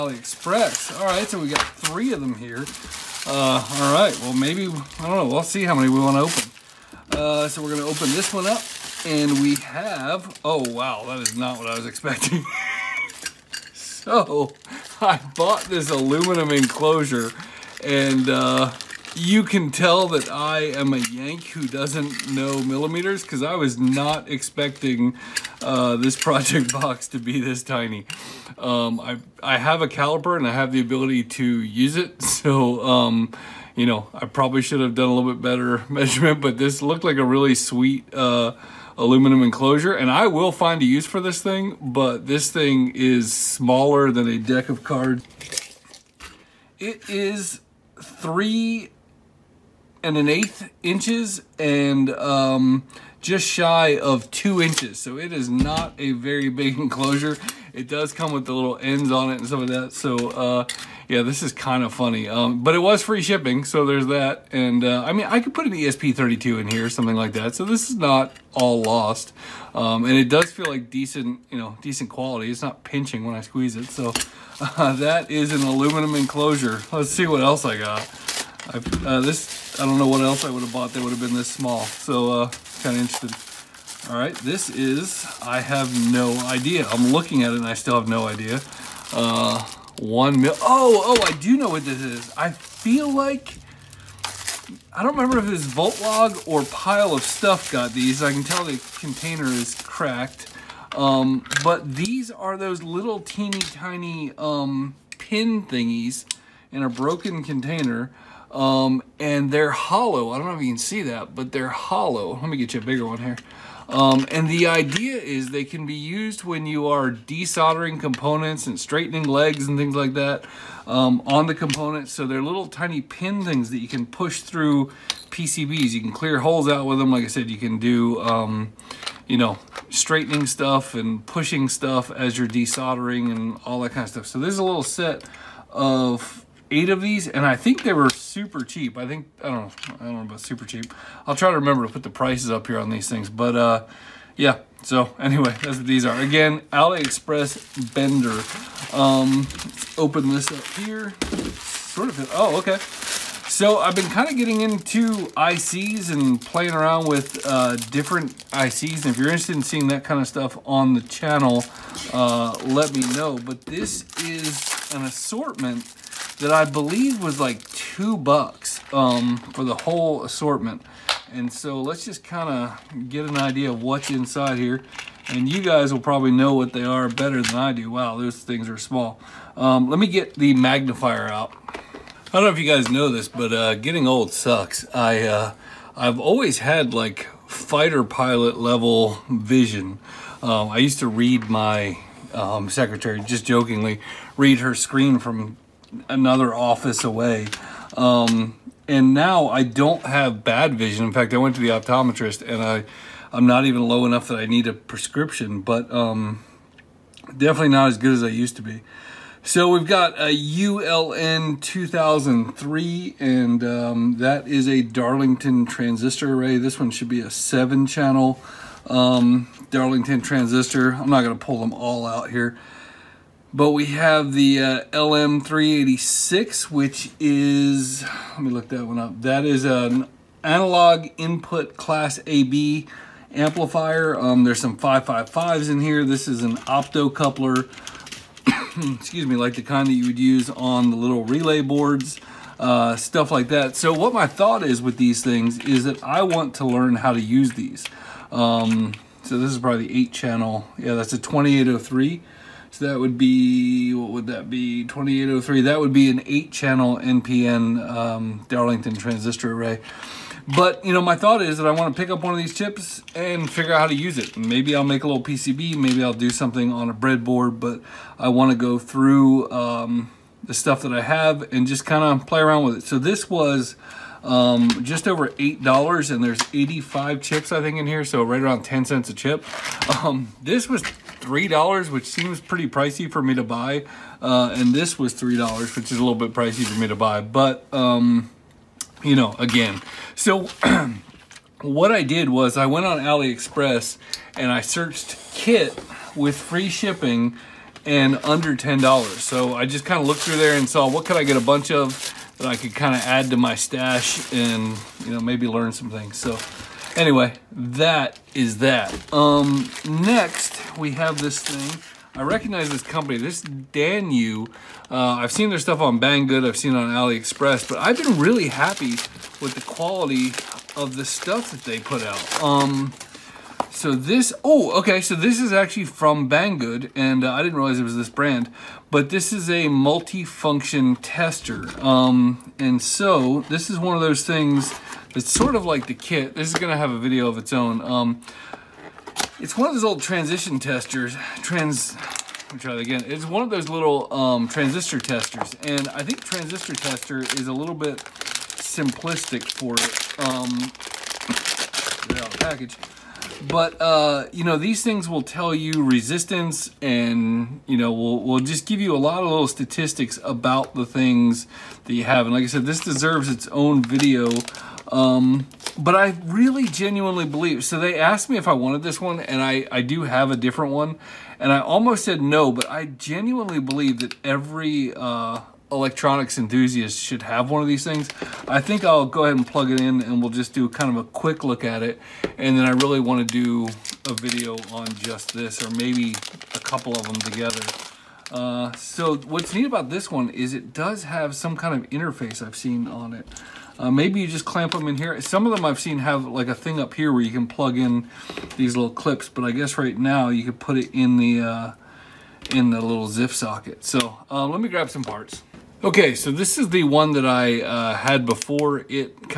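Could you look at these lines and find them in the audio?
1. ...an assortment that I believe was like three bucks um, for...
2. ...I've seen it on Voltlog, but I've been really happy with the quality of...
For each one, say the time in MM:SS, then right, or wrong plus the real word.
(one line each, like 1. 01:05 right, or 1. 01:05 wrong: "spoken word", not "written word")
1. 02:44 wrong: "two", not "three"
2. 05:16 wrong: "AliExpress", not "Voltlog".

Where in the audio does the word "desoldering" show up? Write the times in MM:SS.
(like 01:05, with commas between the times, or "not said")
01:57, 02:12.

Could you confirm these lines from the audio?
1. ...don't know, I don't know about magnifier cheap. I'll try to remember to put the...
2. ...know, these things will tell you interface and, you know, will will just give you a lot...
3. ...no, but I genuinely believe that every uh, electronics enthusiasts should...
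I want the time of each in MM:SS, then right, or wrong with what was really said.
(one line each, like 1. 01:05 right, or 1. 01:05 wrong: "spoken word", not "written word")
1. 02:19 wrong: "super", not "magnifier"
2. 05:54 wrong: "resistance", not "interface"
3. 06:12 right.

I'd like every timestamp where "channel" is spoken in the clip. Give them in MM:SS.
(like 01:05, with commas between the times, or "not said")
02:40, 03:37, 04:10, 04:16.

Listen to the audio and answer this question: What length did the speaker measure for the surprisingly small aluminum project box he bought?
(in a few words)
3 1/8 inches.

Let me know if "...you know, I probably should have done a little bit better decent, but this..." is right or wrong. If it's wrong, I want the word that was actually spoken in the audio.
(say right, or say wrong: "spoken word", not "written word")
wrong: "measurement", not "decent".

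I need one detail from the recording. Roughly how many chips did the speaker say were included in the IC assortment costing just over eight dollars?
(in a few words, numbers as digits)
85.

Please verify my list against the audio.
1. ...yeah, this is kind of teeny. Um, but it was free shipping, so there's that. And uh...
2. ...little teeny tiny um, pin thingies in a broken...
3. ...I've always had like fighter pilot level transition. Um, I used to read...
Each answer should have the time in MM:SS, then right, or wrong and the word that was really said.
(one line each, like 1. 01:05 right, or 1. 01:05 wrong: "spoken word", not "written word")
1. 01:01 wrong: "funny", not "teeny"
2. 01:42 right
3. 03:05 wrong: "vision", not "transition".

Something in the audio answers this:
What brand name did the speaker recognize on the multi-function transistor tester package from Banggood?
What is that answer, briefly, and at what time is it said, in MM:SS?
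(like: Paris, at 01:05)
DANIU, at 05:13.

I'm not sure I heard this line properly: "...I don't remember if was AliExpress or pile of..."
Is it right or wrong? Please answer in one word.
wrong.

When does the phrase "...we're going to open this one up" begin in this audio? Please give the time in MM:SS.
00:07.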